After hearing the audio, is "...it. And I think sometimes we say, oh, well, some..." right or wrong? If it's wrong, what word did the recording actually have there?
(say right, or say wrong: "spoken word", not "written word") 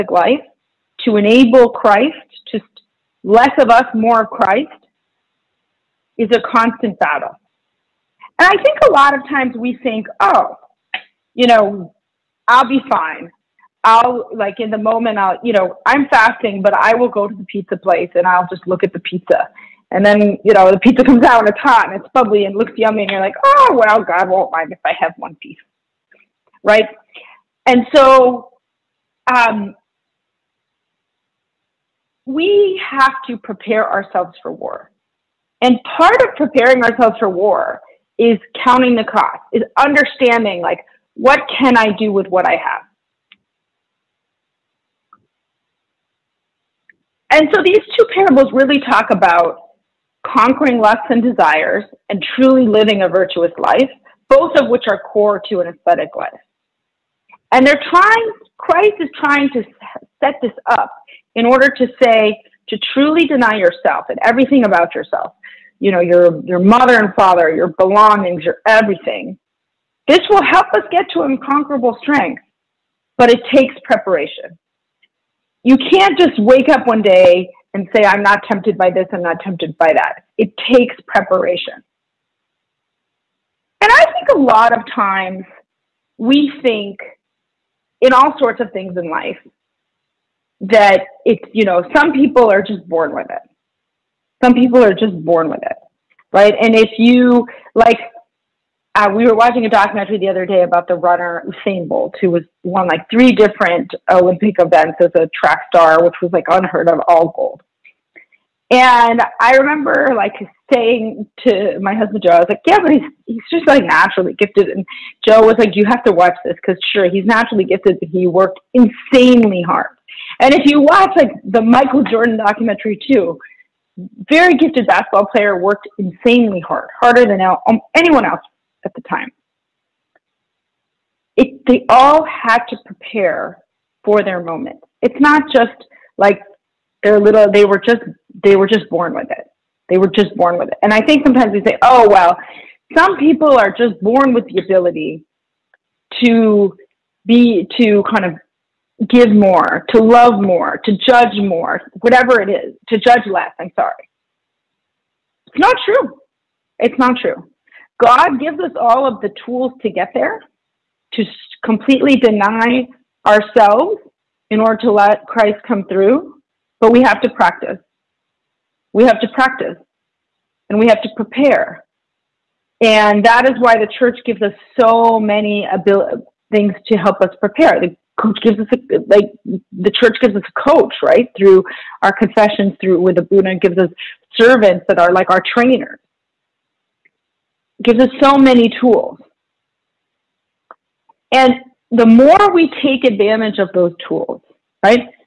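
right.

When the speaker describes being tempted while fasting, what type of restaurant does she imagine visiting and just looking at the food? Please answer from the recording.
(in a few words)
pizza place.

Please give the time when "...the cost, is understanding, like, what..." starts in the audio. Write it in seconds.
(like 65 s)
38 s.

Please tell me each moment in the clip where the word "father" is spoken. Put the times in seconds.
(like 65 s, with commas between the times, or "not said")
67 s.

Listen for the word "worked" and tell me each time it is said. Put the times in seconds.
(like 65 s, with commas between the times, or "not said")
118 s, 125 s.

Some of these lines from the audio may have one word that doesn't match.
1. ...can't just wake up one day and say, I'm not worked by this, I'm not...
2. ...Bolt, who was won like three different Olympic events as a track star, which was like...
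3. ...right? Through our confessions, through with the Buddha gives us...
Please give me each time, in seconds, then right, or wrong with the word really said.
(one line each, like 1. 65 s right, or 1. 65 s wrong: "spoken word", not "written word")
1. 75 s wrong: "tempted", not "worked"
2. 101 s right
3. 181 s right.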